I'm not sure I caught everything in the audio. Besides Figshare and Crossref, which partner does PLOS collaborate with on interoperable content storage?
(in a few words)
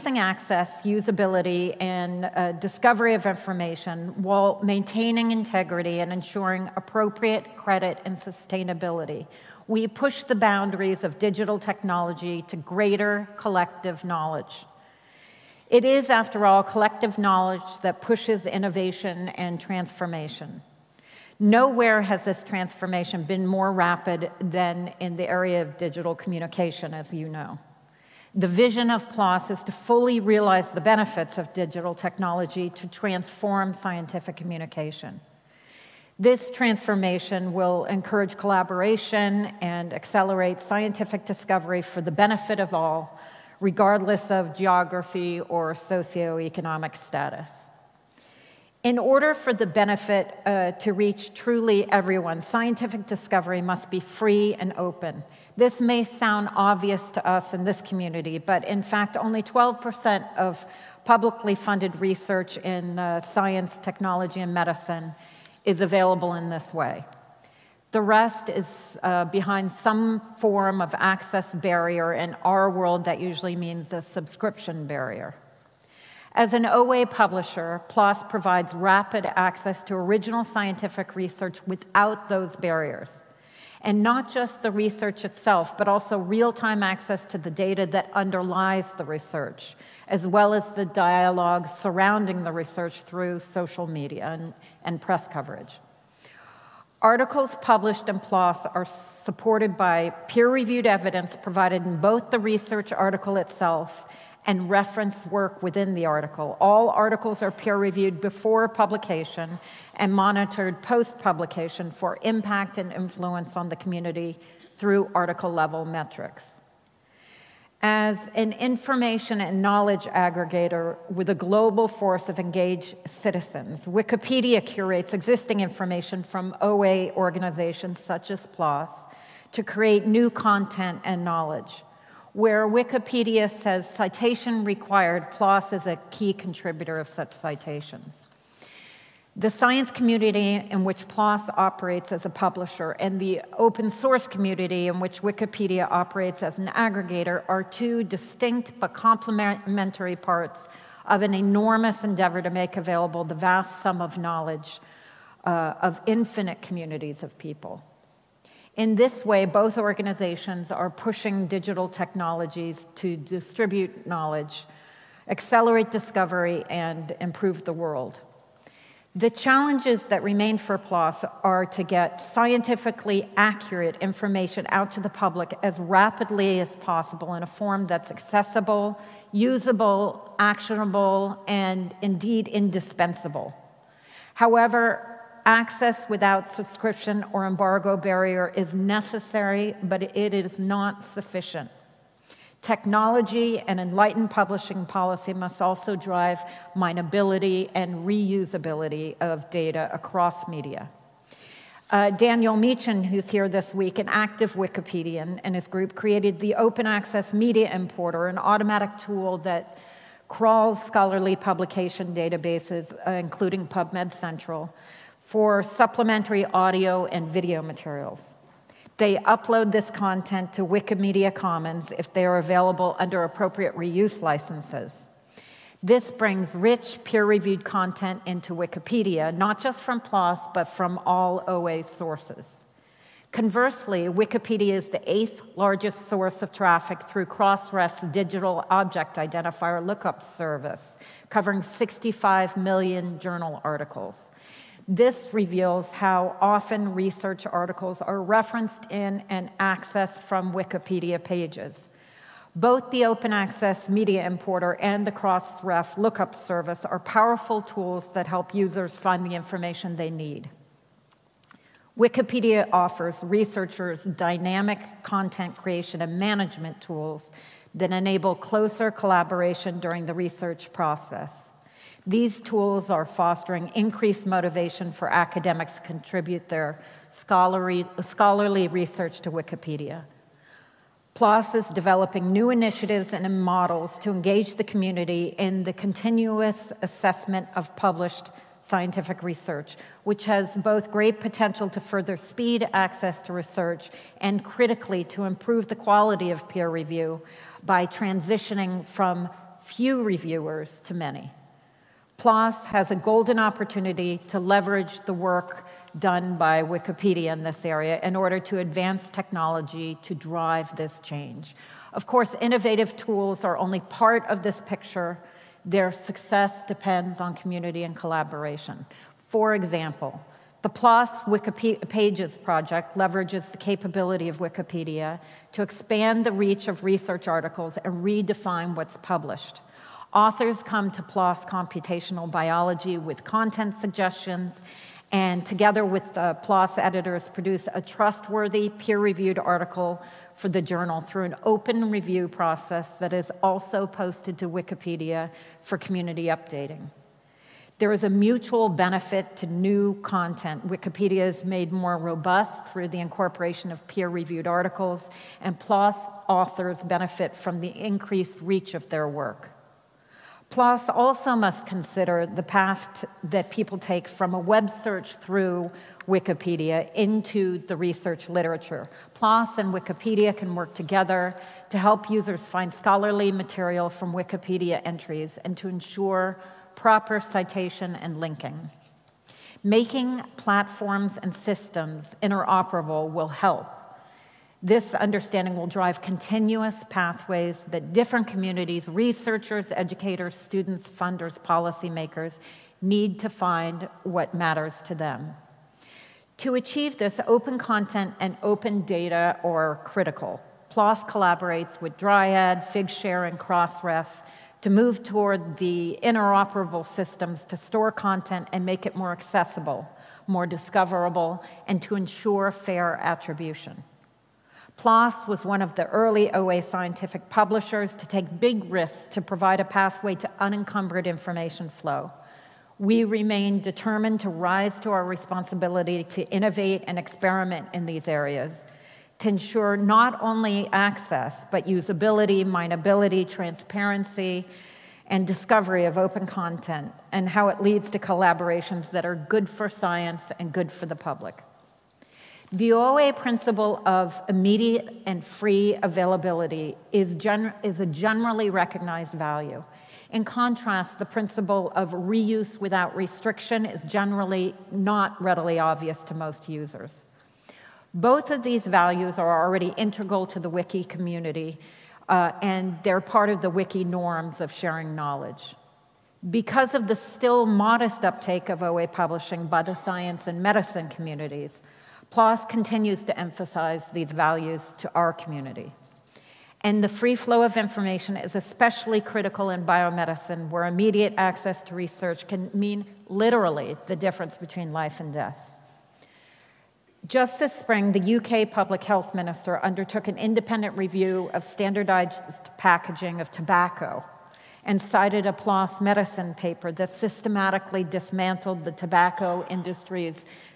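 Dryad.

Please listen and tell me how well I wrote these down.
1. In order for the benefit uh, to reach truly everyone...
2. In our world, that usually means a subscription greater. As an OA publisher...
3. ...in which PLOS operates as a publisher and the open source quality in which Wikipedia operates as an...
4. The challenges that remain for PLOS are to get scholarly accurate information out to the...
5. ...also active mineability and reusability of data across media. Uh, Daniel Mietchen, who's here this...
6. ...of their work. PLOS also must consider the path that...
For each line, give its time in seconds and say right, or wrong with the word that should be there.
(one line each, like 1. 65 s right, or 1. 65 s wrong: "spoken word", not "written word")
1. 48 s right
2. 72 s wrong: "barrier", not "greater"
3. 140 s wrong: "community", not "quality"
4. 169 s wrong: "scientifically", not "scholarly"
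5. 195 s wrong: "drive", not "active"
6. 358 s right.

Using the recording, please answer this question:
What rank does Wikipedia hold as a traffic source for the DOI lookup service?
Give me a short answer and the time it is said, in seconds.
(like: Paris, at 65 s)
eighth largest, at 235 s.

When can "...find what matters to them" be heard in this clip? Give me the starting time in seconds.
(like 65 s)
393 s.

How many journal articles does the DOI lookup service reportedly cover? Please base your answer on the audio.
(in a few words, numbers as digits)
65 million.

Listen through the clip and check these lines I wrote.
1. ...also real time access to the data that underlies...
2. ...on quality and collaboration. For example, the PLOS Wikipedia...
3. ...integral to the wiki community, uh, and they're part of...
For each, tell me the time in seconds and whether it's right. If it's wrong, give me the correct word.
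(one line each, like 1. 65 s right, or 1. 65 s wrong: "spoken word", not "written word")
1. 85 s right
2. 317 s wrong: "community", not "quality"
3. 459 s right.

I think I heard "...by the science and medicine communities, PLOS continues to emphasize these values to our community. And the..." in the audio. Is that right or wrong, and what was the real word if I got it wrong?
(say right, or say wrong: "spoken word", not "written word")
right.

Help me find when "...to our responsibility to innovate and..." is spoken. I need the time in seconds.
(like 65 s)
424 s.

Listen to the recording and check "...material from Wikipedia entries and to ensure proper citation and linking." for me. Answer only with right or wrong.
right.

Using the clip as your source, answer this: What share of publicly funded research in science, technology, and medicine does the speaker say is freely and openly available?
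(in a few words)
12%.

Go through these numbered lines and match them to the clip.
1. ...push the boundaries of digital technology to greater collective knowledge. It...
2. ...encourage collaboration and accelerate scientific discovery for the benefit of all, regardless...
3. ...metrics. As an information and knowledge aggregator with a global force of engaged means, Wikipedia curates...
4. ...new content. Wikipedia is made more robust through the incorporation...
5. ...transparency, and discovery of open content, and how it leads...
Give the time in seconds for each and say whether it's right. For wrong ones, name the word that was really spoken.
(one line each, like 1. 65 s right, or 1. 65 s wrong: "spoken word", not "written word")
1. 9 s right
2. 37 s right
3. 115 s wrong: "citizens", not "means"
4. 349 s right
5. 433 s right.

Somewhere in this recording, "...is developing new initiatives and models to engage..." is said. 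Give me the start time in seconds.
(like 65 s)
281 s.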